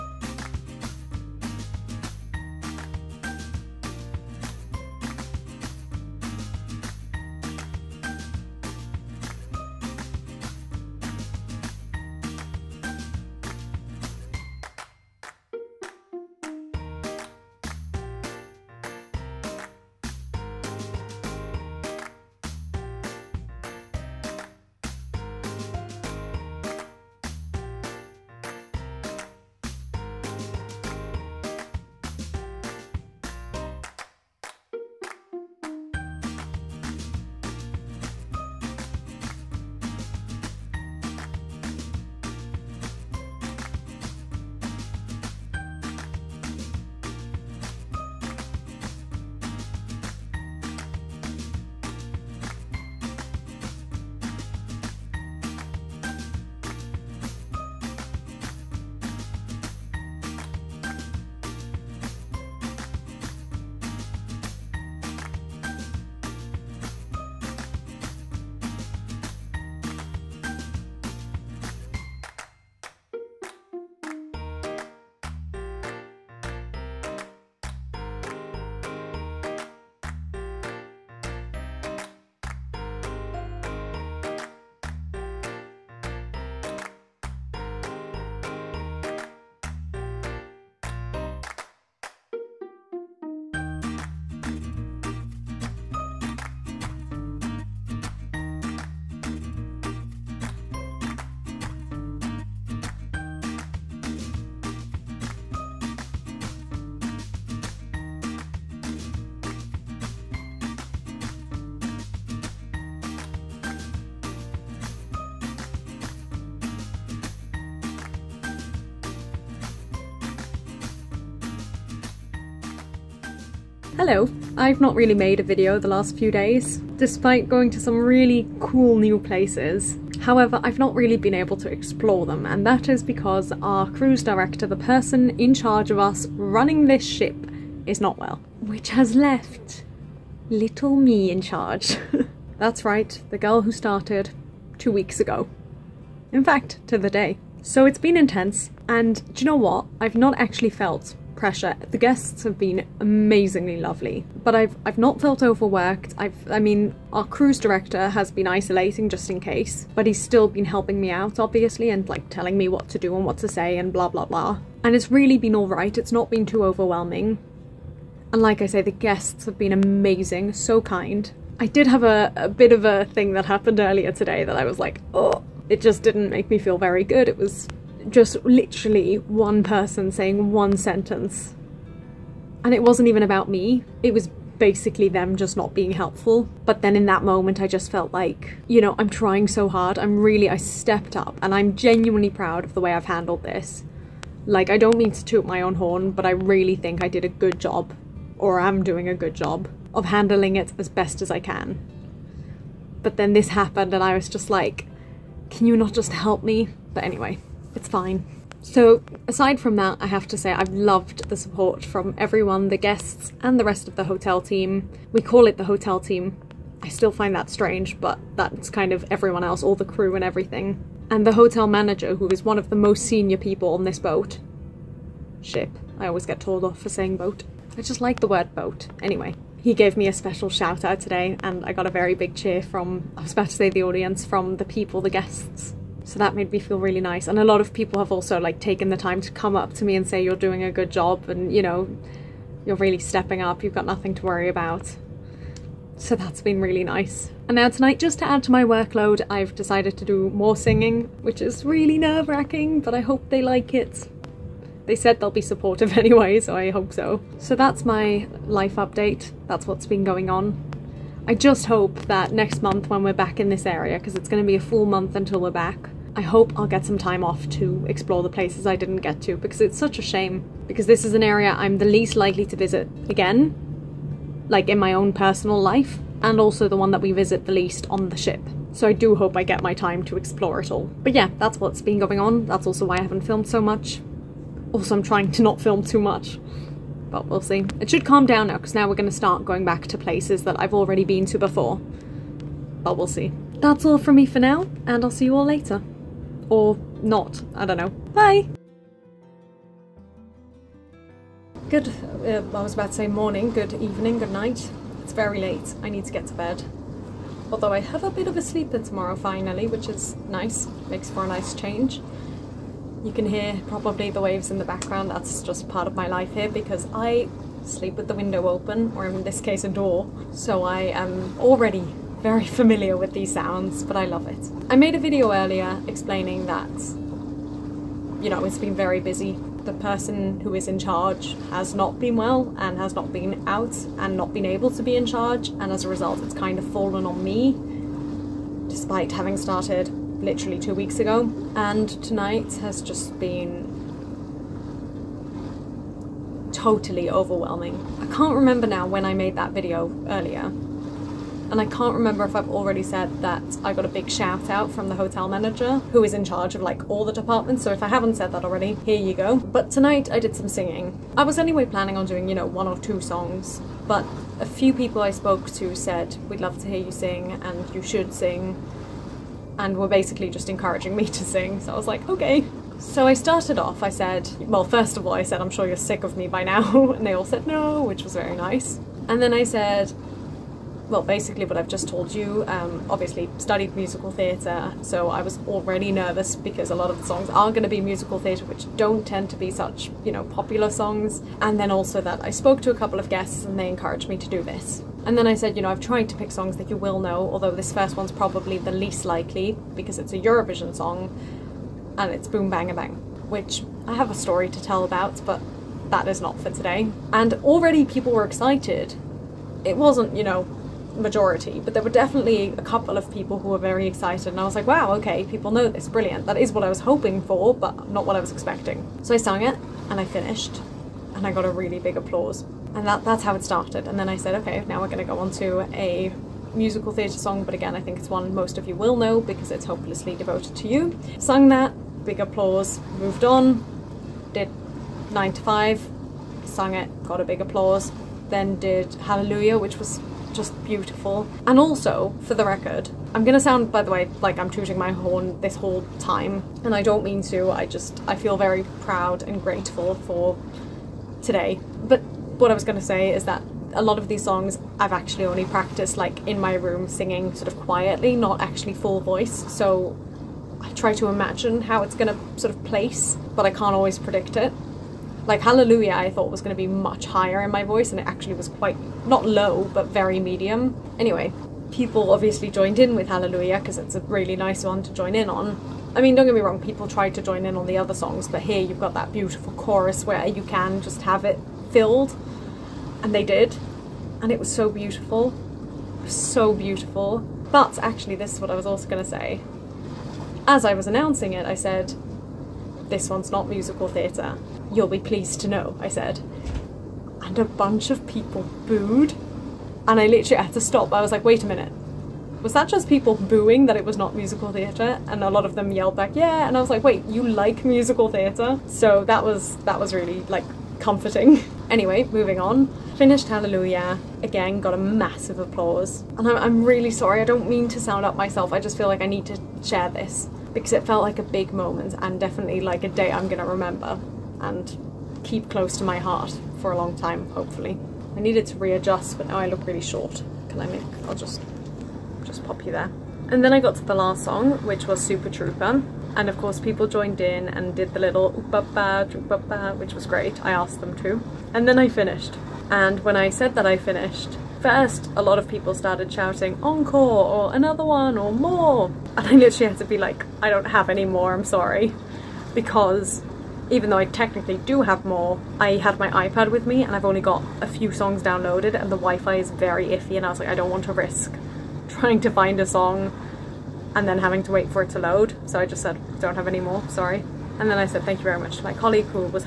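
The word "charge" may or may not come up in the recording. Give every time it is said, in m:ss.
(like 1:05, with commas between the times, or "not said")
2:15, 2:21, 5:30, 5:35, 5:56.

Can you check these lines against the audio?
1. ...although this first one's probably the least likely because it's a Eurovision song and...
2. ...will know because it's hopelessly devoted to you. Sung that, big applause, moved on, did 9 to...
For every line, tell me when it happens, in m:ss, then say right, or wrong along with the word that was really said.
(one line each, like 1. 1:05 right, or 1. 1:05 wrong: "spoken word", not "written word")
1. 6:37 right
2. 7:08 right.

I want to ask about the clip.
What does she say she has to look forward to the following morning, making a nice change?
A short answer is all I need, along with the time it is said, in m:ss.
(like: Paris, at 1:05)
a sleep in, at 5:08.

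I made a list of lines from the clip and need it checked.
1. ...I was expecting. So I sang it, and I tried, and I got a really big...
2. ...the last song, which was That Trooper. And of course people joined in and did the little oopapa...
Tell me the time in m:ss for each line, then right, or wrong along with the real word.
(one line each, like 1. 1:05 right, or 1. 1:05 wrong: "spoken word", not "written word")
1. 6:58 wrong: "finished", not "tried"
2. 8:53 wrong: "Super", not "That".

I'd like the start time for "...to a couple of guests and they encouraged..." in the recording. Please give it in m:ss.
6:32.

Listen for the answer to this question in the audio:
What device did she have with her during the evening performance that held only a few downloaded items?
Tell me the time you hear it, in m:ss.
9:16.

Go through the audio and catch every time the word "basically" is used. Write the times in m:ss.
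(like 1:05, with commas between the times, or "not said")
3:04, 6:09, 6:21.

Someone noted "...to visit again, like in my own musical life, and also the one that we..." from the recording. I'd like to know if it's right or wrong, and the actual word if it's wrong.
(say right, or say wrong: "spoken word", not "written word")
wrong: "personal", not "musical".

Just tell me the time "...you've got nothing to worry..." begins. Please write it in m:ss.
4:03.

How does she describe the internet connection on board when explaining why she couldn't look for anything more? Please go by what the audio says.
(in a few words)
very iffy.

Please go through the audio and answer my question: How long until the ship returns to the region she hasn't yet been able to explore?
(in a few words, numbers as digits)
a full month.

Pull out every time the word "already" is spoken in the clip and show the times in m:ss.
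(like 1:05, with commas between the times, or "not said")
4:50, 5:21, 5:52, 5:58, 6:25, 6:47.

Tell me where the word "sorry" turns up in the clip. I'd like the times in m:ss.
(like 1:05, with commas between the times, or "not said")
8:36, 9:11, 9:26.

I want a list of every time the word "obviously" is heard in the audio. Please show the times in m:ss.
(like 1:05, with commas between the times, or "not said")
2:41, 6:22, 7:52.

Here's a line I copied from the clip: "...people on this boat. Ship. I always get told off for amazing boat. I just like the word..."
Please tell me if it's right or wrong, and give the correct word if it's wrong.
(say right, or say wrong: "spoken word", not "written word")
wrong: "saying", not "amazing".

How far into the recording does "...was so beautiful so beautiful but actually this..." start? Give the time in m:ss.
8:04.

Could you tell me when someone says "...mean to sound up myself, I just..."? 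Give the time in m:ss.
8:37.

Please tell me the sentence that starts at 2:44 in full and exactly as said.
And it's really been all right.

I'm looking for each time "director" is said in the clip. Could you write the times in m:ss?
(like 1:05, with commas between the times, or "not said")
2:14, 2:37.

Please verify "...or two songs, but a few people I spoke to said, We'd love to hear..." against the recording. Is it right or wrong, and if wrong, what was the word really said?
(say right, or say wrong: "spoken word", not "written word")
right.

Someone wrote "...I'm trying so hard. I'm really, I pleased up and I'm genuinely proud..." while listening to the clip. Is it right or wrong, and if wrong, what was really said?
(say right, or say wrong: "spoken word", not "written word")
wrong: "stepped", not "pleased".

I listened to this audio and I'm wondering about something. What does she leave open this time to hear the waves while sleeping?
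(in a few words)
a door.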